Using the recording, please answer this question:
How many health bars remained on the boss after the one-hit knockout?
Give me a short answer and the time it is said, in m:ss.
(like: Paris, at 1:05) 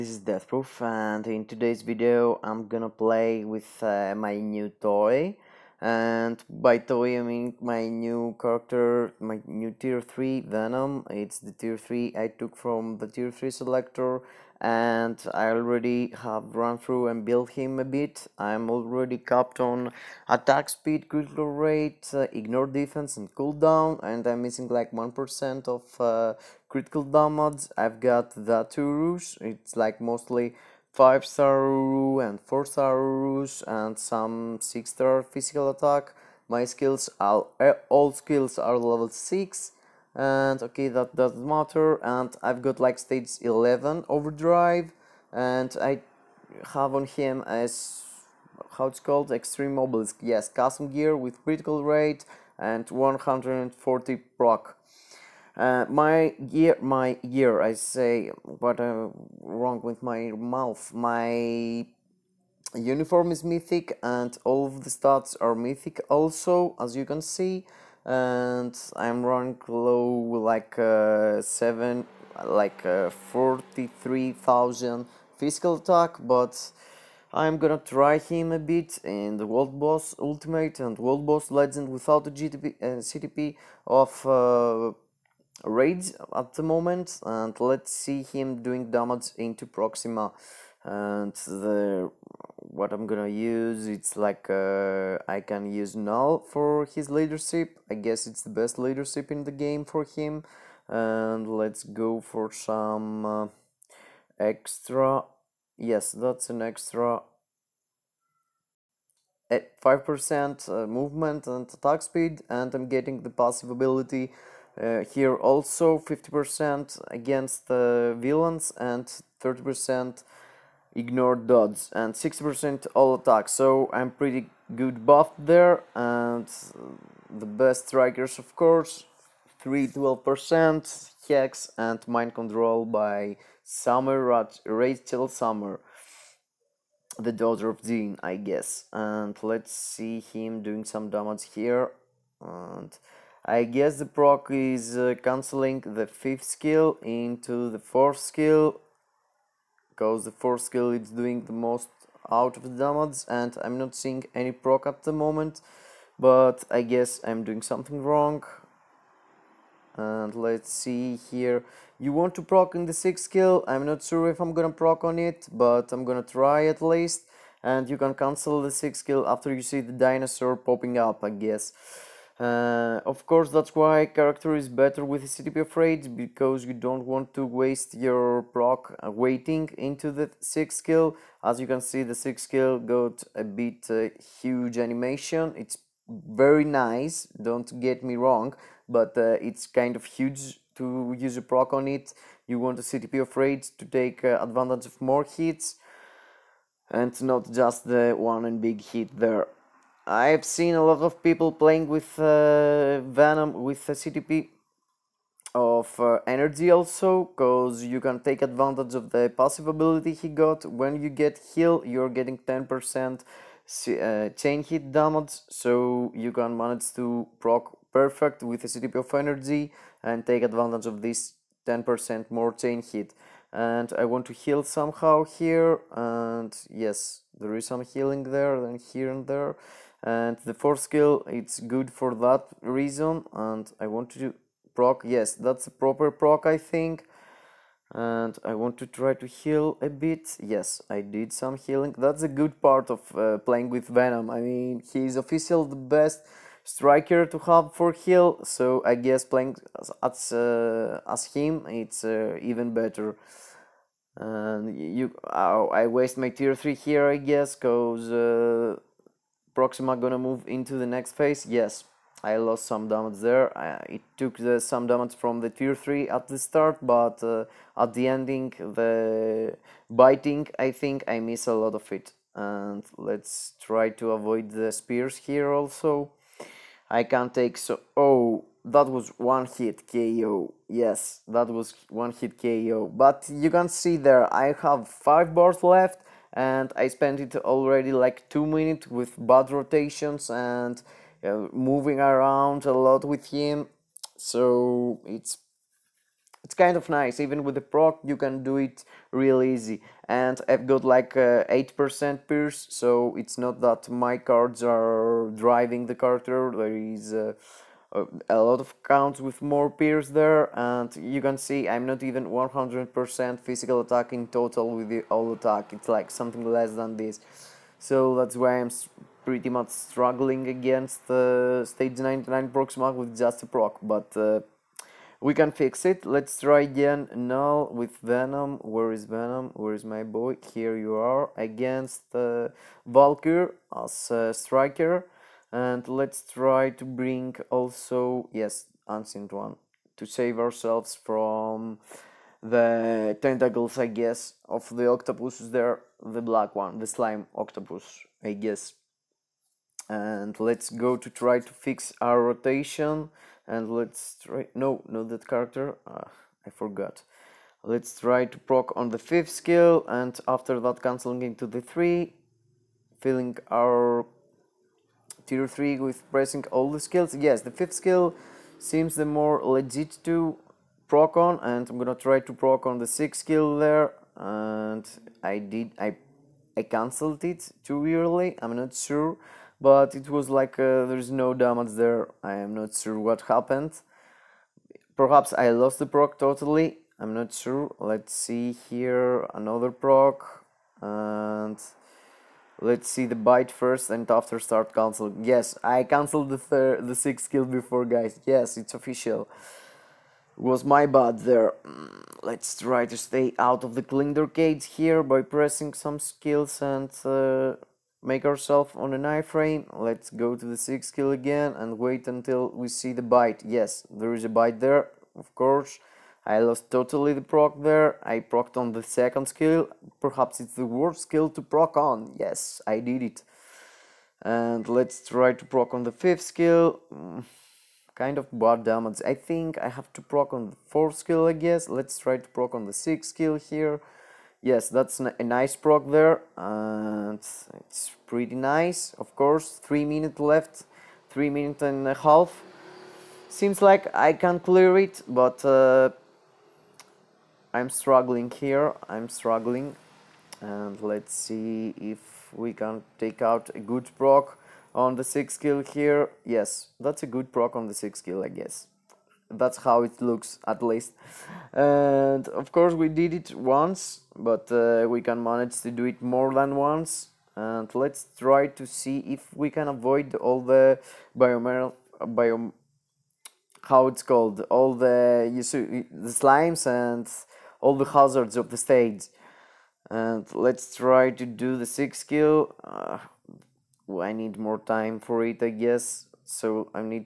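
5, at 4:44.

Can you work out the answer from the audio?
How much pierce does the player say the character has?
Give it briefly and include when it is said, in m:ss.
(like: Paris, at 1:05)
8%, at 5:01.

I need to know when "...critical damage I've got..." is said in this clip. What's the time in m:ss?
0:26.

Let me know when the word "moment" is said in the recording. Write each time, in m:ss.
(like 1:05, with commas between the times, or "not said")
1:26, 2:35.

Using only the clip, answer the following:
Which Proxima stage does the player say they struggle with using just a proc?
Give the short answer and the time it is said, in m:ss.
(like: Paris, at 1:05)
99, at 5:21.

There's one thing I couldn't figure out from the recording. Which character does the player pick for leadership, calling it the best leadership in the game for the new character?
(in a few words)
Knull.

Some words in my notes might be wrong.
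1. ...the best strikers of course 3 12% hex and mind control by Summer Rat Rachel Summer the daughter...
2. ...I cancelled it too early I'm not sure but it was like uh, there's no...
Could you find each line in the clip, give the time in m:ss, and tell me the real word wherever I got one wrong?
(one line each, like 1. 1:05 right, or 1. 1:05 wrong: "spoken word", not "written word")
1. 2:07 right
2. 6:16 right.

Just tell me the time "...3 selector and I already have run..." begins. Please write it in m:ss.
0:13.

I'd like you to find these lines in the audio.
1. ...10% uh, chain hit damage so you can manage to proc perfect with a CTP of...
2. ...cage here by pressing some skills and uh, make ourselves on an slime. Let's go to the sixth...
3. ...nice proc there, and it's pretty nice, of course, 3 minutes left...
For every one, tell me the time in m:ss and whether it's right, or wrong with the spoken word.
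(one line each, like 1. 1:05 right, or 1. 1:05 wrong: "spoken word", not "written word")
1. 3:32 right
2. 6:44 wrong: "iframe", not "slime"
3. 7:15 right.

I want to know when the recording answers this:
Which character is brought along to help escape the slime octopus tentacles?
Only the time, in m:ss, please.
5:38.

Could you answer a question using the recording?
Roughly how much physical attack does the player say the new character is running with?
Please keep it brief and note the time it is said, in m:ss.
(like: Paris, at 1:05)
43000, at 1:13.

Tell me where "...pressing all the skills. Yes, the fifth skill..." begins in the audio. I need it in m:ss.
6:06.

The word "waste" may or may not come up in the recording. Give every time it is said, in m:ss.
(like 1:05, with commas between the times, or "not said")
2:57, 4:15.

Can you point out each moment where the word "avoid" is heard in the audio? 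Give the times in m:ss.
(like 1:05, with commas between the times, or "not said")
4:34, 7:49.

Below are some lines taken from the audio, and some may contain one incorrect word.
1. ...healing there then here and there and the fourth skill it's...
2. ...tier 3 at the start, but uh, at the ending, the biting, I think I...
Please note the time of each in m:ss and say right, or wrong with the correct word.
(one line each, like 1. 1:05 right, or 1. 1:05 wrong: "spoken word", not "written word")
1. 3:47 right
2. 4:25 right.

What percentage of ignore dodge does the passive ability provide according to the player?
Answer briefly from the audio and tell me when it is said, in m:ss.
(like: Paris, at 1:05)
30%, at 1:59.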